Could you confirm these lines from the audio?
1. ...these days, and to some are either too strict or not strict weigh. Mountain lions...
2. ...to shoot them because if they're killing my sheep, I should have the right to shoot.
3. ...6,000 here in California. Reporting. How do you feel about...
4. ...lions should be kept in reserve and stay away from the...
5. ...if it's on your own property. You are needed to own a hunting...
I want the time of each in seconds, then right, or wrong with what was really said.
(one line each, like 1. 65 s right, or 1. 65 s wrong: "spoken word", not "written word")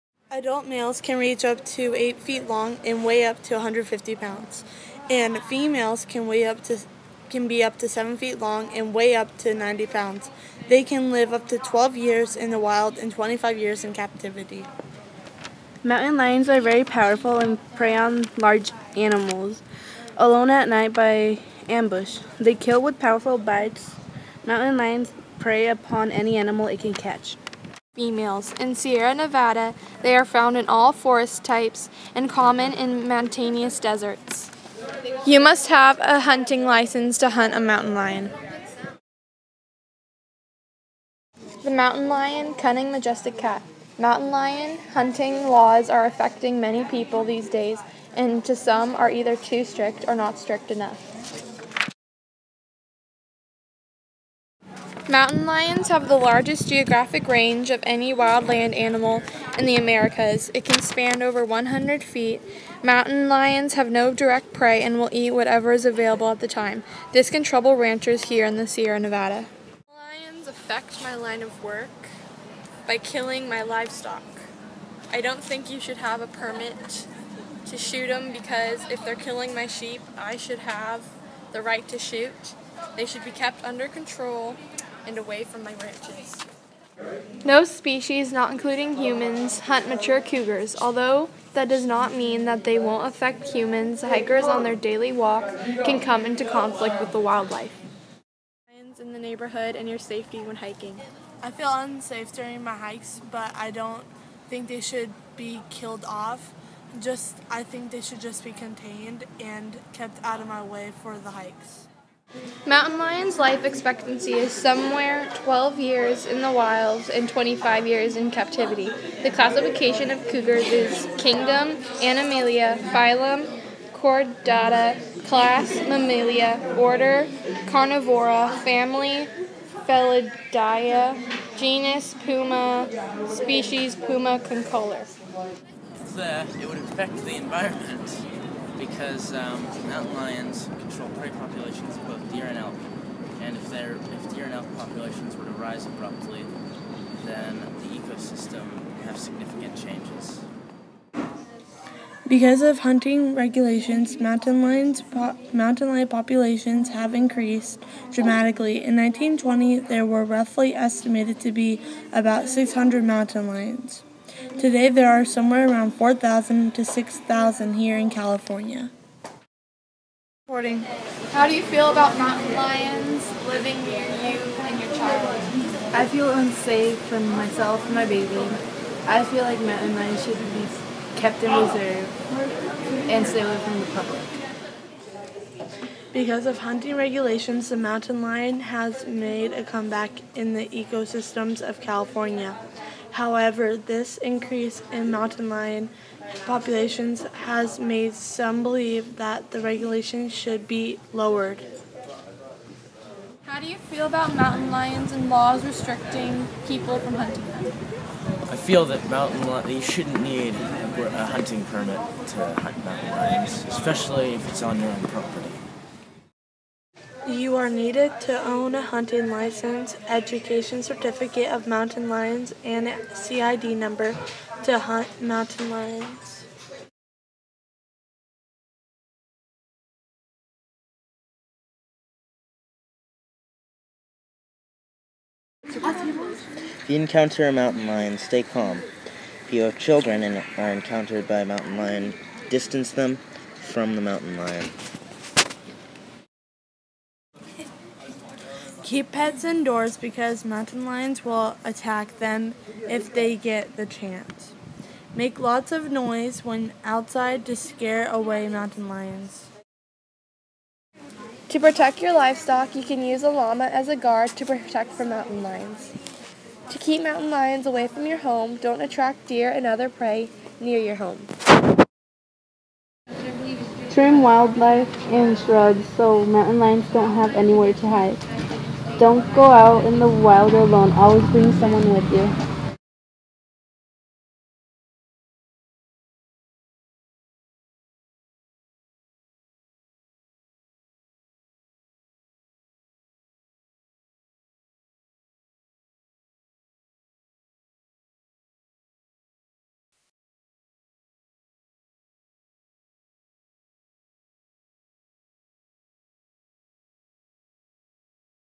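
1. 47 s wrong: "enough", not "weigh"
2. 77 s right
3. 166 s right
4. 179 s right
5. 214 s right.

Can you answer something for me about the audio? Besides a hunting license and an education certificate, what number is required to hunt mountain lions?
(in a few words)
CID number.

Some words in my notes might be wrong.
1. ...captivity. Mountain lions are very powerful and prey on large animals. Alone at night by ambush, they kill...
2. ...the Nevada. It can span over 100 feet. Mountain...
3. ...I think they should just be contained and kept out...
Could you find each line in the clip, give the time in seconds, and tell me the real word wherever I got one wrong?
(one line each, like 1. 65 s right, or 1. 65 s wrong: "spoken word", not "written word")
1. 13 s right
2. 59 s wrong: "Americas", not "Nevada"
3. 107 s right.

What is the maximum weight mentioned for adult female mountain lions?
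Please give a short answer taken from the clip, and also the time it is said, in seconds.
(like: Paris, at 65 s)
90 pounds, at 9 s.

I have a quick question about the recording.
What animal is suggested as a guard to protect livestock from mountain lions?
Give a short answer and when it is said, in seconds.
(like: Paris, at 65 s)
llama, at 263 s.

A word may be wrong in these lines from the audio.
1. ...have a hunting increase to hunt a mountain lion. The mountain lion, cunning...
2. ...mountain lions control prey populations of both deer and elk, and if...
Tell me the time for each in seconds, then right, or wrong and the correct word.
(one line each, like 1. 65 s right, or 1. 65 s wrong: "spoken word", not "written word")
1. 35 s wrong: "license", not "increase"
2. 139 s right.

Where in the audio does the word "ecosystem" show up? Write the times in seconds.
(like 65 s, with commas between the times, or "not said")
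147 s, 190 s.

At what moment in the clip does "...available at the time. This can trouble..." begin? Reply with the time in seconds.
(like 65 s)
65 s.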